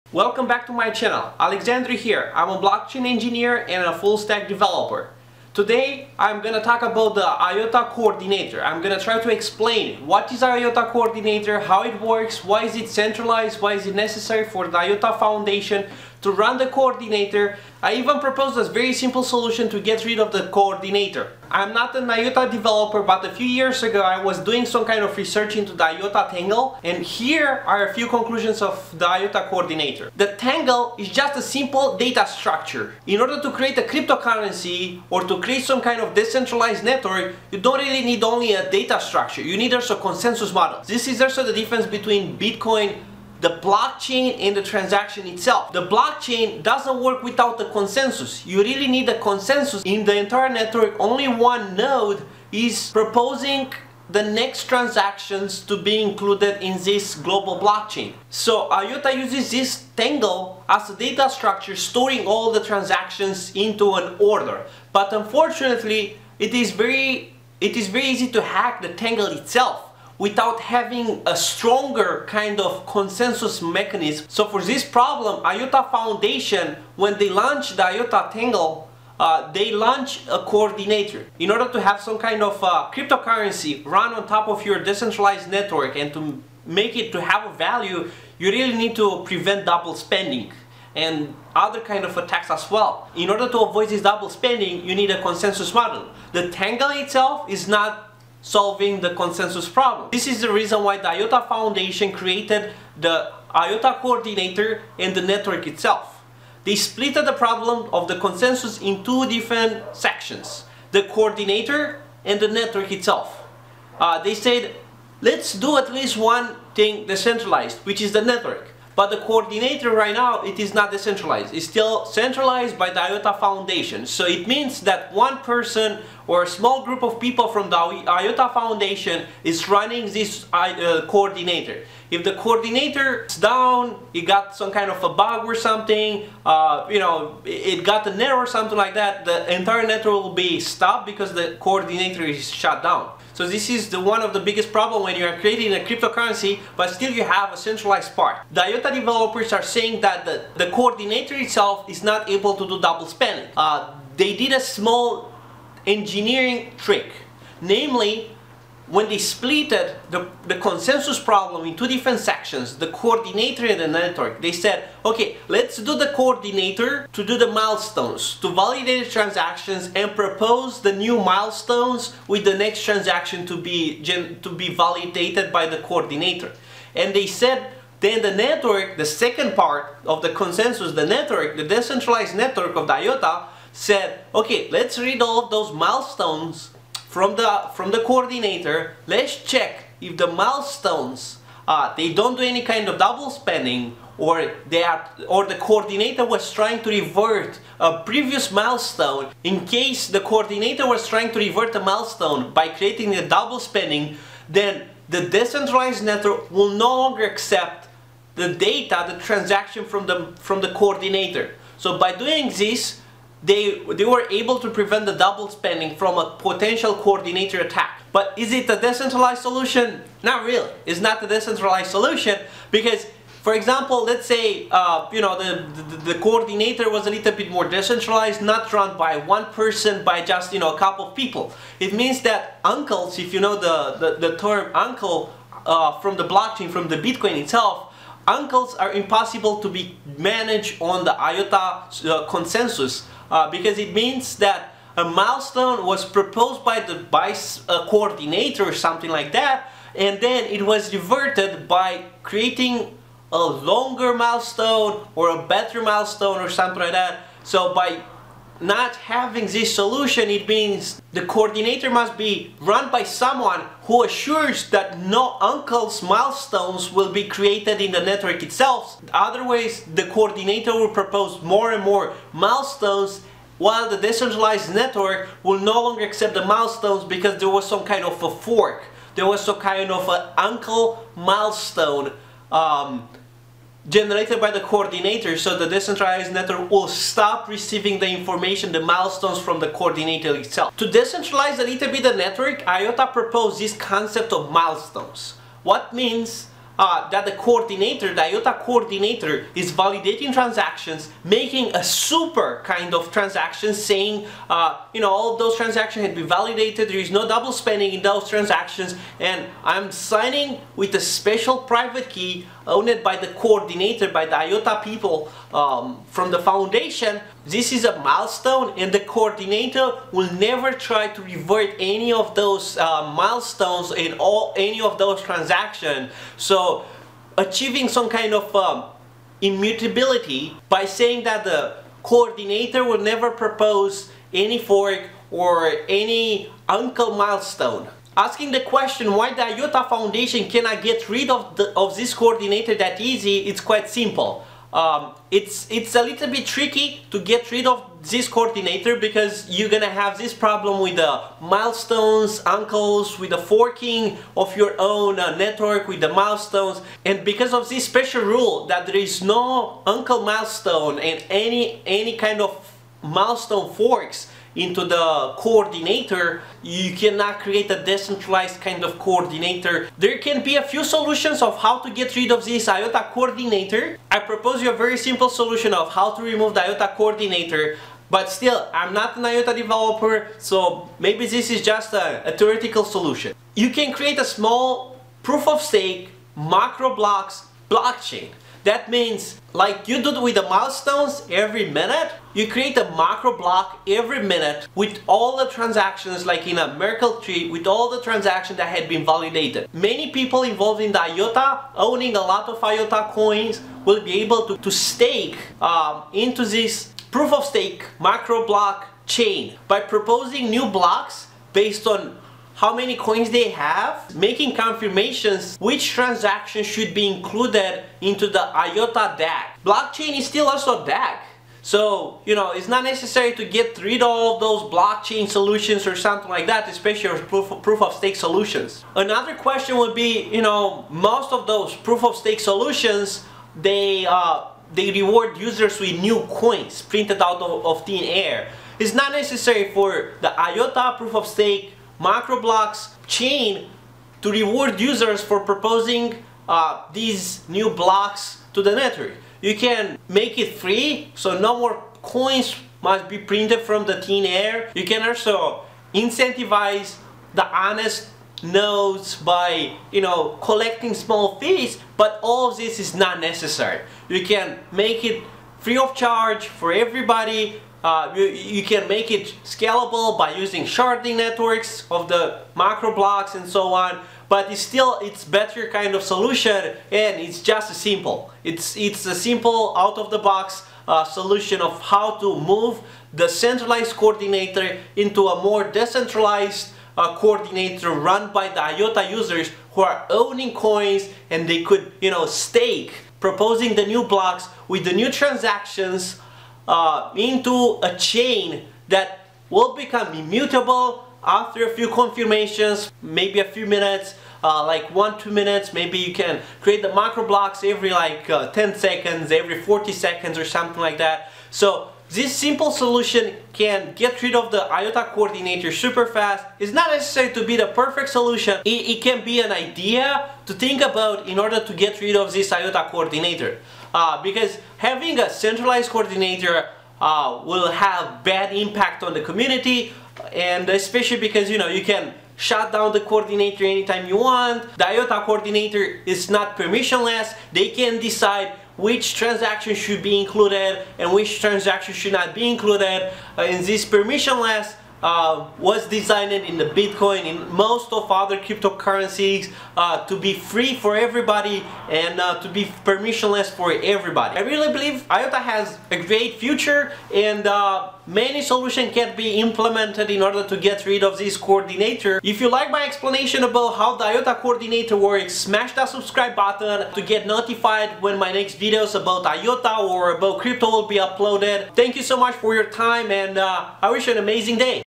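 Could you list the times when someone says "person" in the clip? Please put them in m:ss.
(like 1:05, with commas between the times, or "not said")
2:05, 3:49.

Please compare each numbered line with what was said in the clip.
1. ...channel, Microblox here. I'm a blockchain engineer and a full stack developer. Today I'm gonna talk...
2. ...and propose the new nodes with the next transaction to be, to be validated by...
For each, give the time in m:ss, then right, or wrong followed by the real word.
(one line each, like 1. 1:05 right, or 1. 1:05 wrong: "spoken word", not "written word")
1. 0:00 wrong: "Alexandru", not "Microblox"
2. 2:49 wrong: "milestones", not "nodes".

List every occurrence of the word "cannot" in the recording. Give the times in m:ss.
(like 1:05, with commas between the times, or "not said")
5:40, 6:06.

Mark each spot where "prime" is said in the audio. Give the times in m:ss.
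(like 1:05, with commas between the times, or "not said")
not said.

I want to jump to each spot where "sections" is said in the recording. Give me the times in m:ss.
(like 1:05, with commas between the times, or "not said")
1:49, 2:42.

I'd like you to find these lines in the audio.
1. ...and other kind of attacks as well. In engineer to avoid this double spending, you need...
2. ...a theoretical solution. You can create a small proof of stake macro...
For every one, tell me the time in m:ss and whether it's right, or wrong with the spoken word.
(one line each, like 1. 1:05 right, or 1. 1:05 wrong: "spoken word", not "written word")
1. 1:30 wrong: "order", not "engineer"
2. 6:22 right.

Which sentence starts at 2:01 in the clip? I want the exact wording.
It's still centralized by the IOTA Foundation.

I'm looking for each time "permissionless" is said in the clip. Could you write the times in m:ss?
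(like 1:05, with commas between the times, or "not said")
8:56, 9:03, 9:12.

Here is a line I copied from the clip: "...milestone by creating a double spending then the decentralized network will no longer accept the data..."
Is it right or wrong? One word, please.
right.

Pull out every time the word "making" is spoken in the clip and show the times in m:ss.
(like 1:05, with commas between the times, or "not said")
5:01, 6:54.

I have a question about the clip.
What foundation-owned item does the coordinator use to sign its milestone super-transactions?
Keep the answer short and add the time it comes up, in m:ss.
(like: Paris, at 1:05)
Special private key, at 5:10.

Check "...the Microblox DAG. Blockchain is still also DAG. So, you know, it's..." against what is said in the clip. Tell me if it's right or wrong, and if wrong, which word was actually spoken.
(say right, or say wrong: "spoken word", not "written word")
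wrong: "IOTA", not "Microblox".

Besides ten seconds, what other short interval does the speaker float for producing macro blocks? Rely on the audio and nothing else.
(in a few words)
40 seconds.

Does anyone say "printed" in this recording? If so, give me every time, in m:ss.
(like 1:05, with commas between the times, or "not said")
7:16, 7:33.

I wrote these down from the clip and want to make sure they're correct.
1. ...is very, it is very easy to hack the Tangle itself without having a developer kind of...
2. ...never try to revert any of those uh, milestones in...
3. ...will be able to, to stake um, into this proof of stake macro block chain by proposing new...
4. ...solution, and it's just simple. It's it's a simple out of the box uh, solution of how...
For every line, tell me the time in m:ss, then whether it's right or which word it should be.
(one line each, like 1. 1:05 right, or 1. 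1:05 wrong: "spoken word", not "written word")
1. 1:06 wrong: "stronger", not "developer"
2. 5:20 right
3. 6:43 right
4. 7:56 right.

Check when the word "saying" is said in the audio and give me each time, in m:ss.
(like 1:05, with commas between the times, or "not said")
2:29, 5:03, 5:30.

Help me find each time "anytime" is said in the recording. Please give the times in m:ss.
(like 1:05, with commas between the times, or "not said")
8:53.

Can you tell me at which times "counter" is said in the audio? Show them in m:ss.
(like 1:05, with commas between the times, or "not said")
not said.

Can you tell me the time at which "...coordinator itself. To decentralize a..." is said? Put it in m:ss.
4:49.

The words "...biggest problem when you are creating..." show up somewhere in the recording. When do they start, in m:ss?
2:24.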